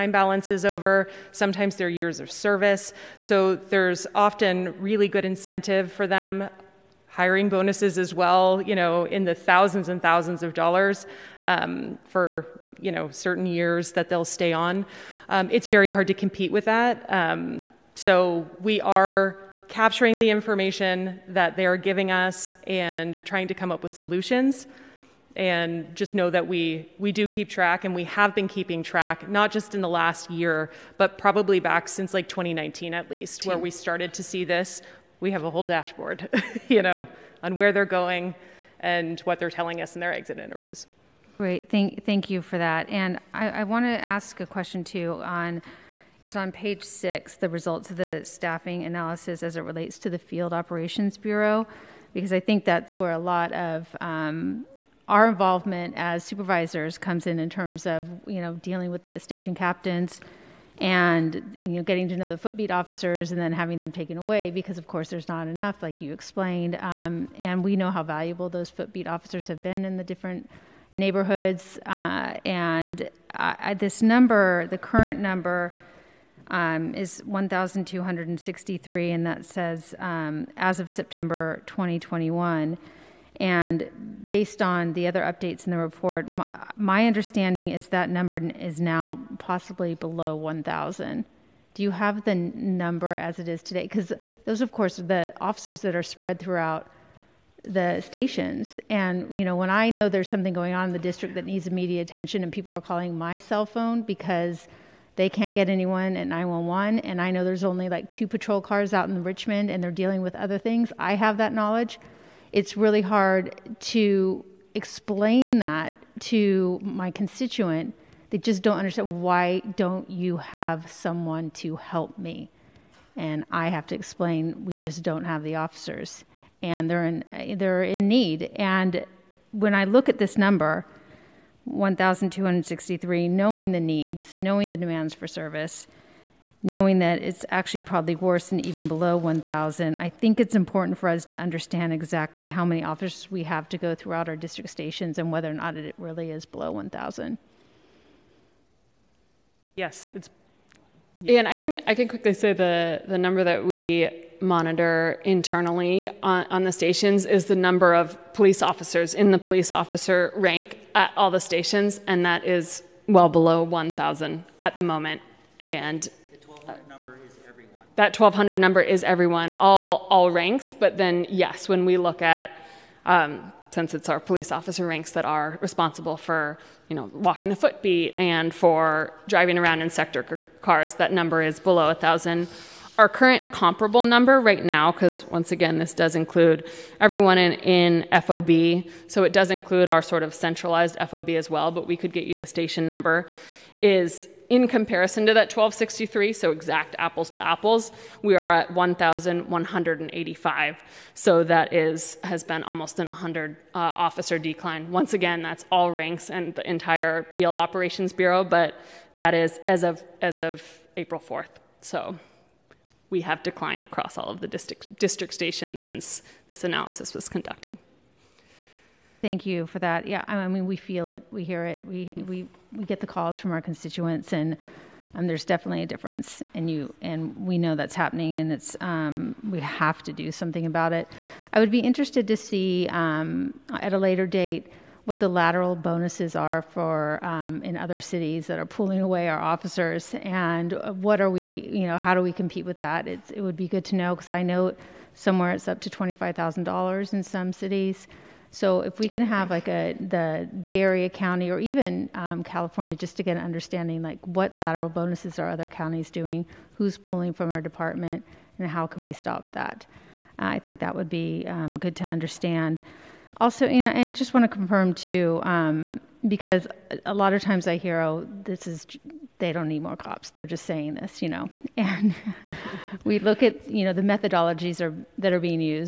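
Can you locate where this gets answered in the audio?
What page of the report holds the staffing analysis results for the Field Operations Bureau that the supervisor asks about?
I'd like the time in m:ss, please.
0:46.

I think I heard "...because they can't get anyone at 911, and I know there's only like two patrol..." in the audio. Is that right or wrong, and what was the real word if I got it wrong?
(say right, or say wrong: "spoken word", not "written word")
right.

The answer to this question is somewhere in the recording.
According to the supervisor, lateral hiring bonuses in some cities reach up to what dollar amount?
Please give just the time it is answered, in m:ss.
4:05.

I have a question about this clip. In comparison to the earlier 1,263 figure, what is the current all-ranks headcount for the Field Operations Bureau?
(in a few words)
1,185.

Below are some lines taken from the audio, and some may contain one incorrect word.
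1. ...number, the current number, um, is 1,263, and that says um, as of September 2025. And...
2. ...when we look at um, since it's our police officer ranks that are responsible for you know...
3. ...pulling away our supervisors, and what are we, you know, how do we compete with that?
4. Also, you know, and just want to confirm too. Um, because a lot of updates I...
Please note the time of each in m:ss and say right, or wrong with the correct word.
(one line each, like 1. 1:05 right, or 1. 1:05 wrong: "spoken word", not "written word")
1. 1:14 wrong: "2021", not "2025"
2. 2:51 right
3. 3:58 wrong: "officers", not "supervisors"
4. 4:23 wrong: "times", not "updates".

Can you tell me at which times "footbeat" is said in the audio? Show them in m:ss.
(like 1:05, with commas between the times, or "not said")
1:02, 1:08, 2:57.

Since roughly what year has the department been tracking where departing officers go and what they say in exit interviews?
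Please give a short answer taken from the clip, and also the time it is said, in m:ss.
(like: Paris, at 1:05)
2019, at 0:32.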